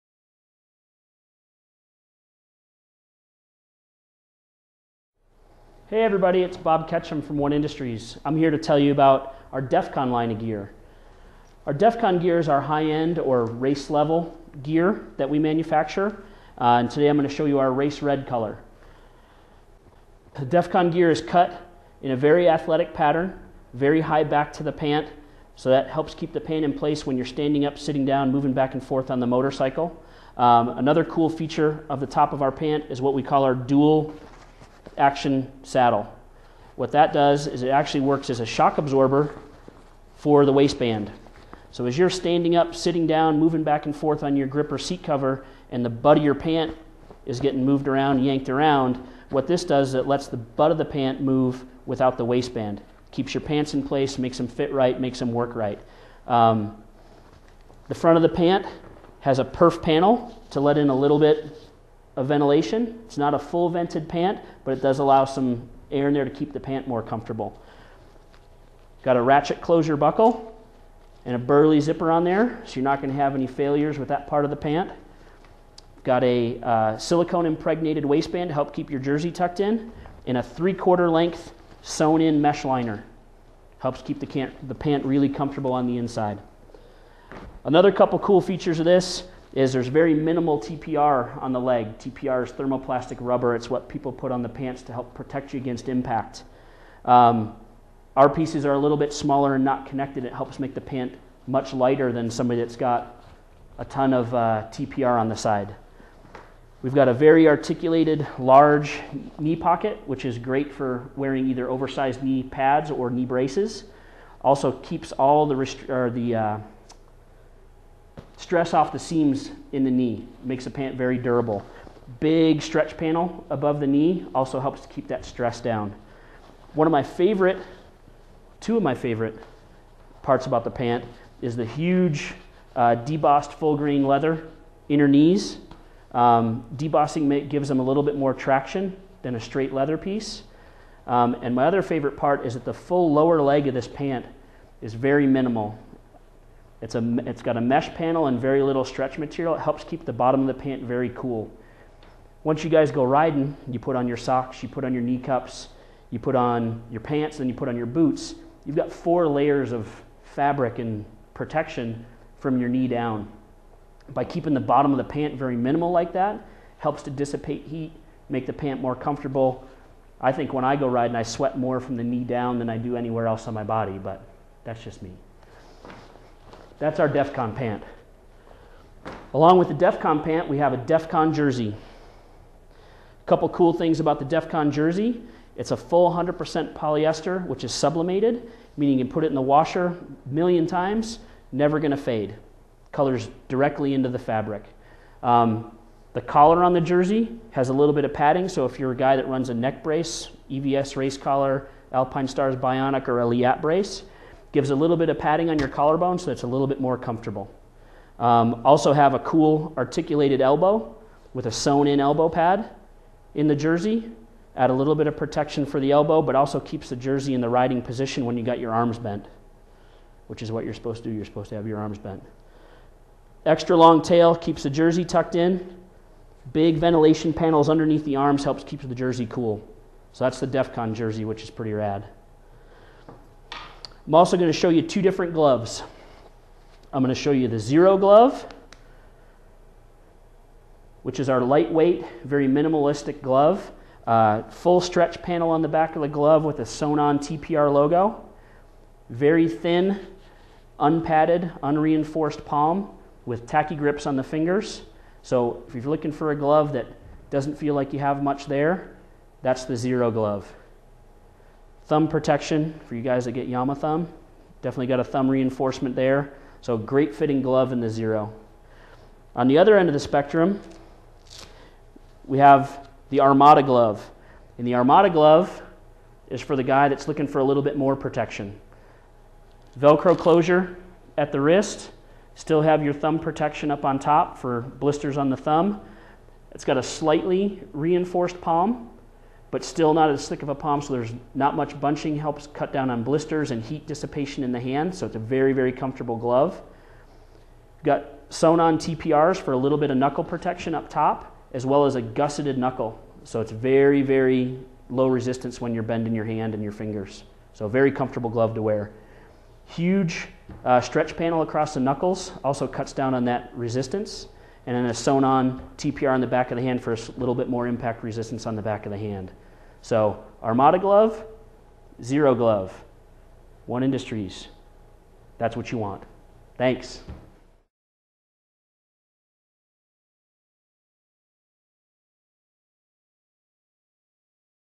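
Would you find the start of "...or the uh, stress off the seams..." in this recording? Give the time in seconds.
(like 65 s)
115 s.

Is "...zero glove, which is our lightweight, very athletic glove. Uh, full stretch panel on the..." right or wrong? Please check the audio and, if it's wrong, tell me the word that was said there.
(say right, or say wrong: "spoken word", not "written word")
wrong: "minimalistic", not "athletic".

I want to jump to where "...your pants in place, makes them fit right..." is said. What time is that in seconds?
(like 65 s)
53 s.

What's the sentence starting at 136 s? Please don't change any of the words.
Um, debossing may, gives them a little bit more traction than a straight leather piece.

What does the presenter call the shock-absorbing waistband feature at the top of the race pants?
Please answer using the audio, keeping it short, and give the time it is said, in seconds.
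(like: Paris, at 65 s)
dual action saddle, at 33 s.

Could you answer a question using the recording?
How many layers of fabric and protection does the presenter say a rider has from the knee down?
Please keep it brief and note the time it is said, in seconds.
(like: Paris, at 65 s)
4, at 158 s.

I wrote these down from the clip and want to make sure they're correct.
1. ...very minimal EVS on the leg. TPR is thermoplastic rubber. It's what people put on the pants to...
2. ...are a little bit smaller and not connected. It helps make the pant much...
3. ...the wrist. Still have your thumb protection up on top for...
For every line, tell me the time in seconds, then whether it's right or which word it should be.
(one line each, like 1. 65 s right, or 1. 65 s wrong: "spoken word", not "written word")
1. 89 s wrong: "TPR", not "EVS"
2. 98 s right
3. 281 s right.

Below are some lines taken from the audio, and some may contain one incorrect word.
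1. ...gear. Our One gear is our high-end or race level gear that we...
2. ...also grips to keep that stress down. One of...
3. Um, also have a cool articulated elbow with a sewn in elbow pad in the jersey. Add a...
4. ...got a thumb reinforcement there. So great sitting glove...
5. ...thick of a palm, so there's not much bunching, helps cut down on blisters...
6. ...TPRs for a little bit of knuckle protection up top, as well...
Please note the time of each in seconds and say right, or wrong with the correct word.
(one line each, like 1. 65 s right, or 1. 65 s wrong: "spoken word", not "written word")
1. 10 s wrong: "Defcon", not "One"
2. 124 s wrong: "helps", not "grips"
3. 208 s right
4. 264 s wrong: "fitting", not "sitting"
5. 290 s right
6. 298 s right.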